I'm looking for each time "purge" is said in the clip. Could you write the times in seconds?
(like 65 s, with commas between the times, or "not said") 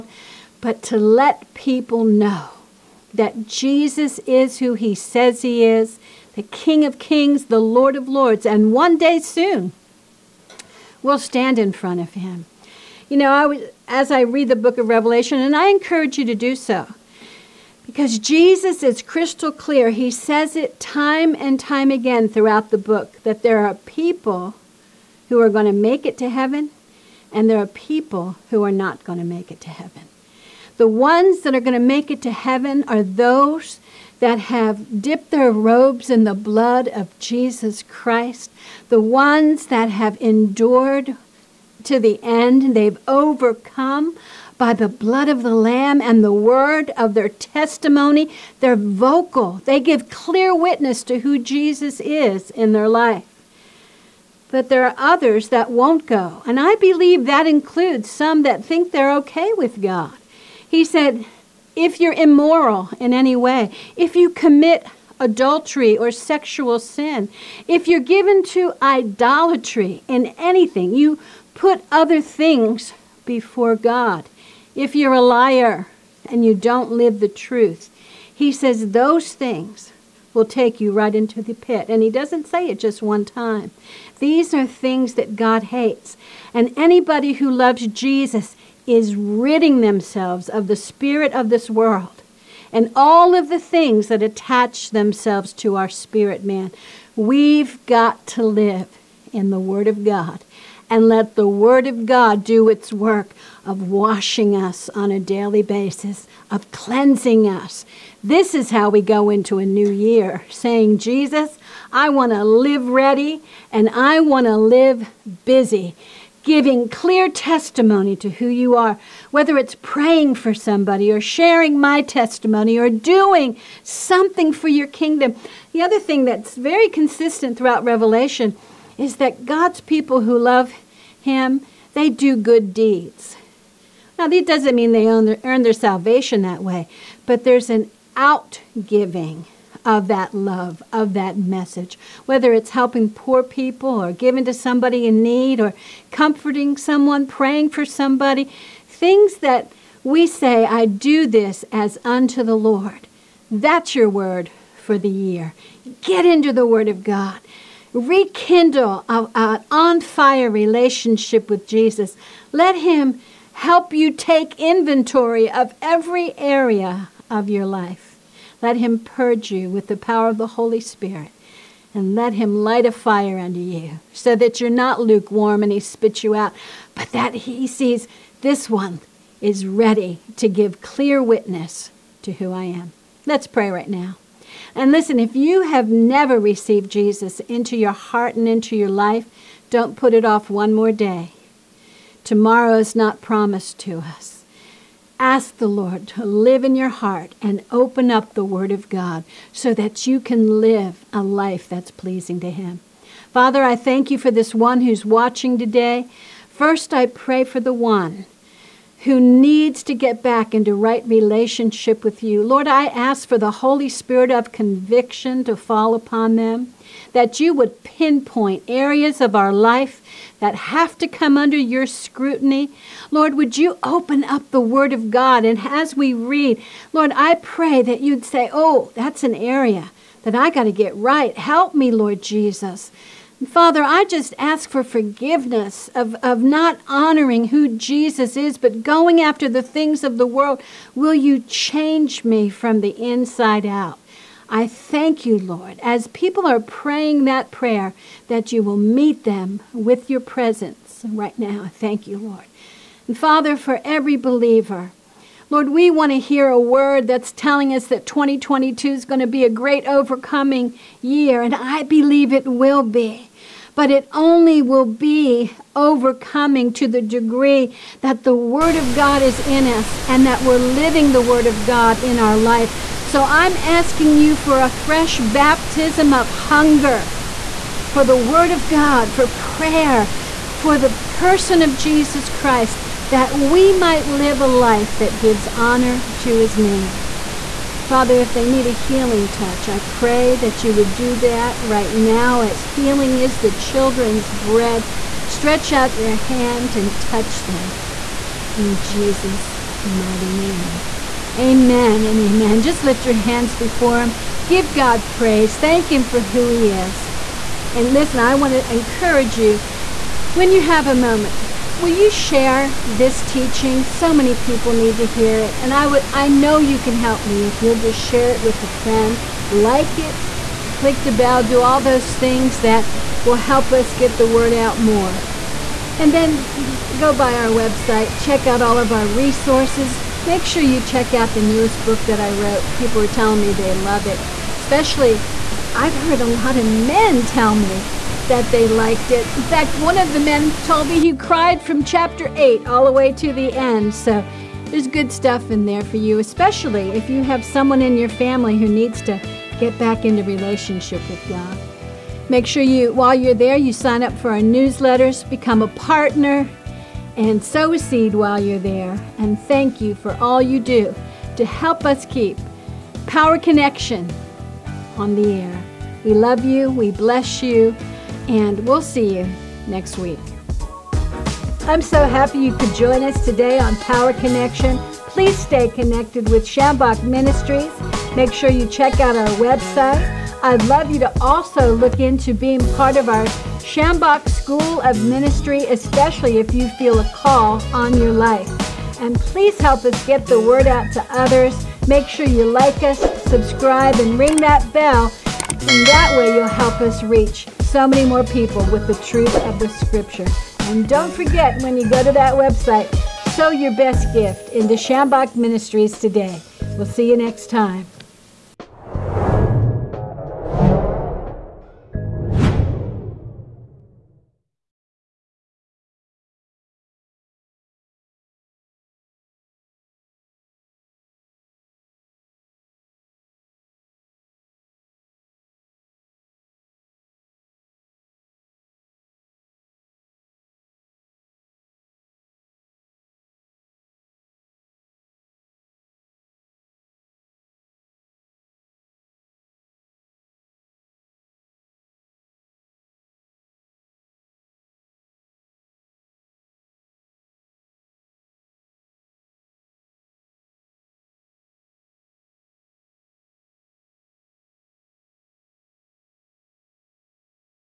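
168 s.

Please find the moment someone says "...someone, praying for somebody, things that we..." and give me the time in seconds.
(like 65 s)
146 s.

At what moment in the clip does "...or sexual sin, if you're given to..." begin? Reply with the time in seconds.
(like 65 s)
65 s.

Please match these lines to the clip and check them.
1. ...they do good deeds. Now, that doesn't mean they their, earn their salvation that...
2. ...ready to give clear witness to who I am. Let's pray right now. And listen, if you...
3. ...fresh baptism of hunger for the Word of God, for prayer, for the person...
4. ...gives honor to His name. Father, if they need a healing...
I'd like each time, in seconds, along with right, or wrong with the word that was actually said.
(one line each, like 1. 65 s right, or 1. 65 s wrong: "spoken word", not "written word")
1. 131 s right
2. 179 s right
3. 274 s right
4. 285 s right.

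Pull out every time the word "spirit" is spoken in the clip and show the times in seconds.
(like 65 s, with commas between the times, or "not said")
90 s, 95 s, 170 s, 213 s.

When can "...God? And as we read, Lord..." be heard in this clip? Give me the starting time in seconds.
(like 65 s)
225 s.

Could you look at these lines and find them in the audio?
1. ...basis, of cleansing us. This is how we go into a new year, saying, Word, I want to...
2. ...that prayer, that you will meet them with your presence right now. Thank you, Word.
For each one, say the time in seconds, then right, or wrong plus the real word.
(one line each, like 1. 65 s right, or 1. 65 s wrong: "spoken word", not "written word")
1. 105 s wrong: "Jesus", not "Word"
2. 247 s wrong: "Lord", not "Word".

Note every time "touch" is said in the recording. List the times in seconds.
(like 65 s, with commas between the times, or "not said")
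289 s, 296 s.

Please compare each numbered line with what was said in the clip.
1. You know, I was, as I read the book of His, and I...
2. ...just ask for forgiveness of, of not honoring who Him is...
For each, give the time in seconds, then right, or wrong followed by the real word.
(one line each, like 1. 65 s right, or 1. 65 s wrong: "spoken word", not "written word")
1. 13 s wrong: "Revelation", not "His"
2. 234 s wrong: "Jesus", not "Him".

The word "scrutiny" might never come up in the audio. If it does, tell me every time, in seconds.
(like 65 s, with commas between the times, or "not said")
221 s.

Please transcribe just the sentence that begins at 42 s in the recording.
They've overcome by the blood of the Lamb and the word of their testimony.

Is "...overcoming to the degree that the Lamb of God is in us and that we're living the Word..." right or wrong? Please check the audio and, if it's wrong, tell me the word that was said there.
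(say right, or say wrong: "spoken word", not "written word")
wrong: "Word", not "Lamb".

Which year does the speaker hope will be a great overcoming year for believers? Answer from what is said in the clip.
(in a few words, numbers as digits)
2022.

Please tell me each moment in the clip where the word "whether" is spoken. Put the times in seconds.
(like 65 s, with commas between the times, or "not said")
119 s, 142 s.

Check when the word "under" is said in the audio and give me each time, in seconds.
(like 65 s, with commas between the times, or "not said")
173 s, 221 s.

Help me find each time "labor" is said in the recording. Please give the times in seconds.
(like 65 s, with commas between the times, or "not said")
not said.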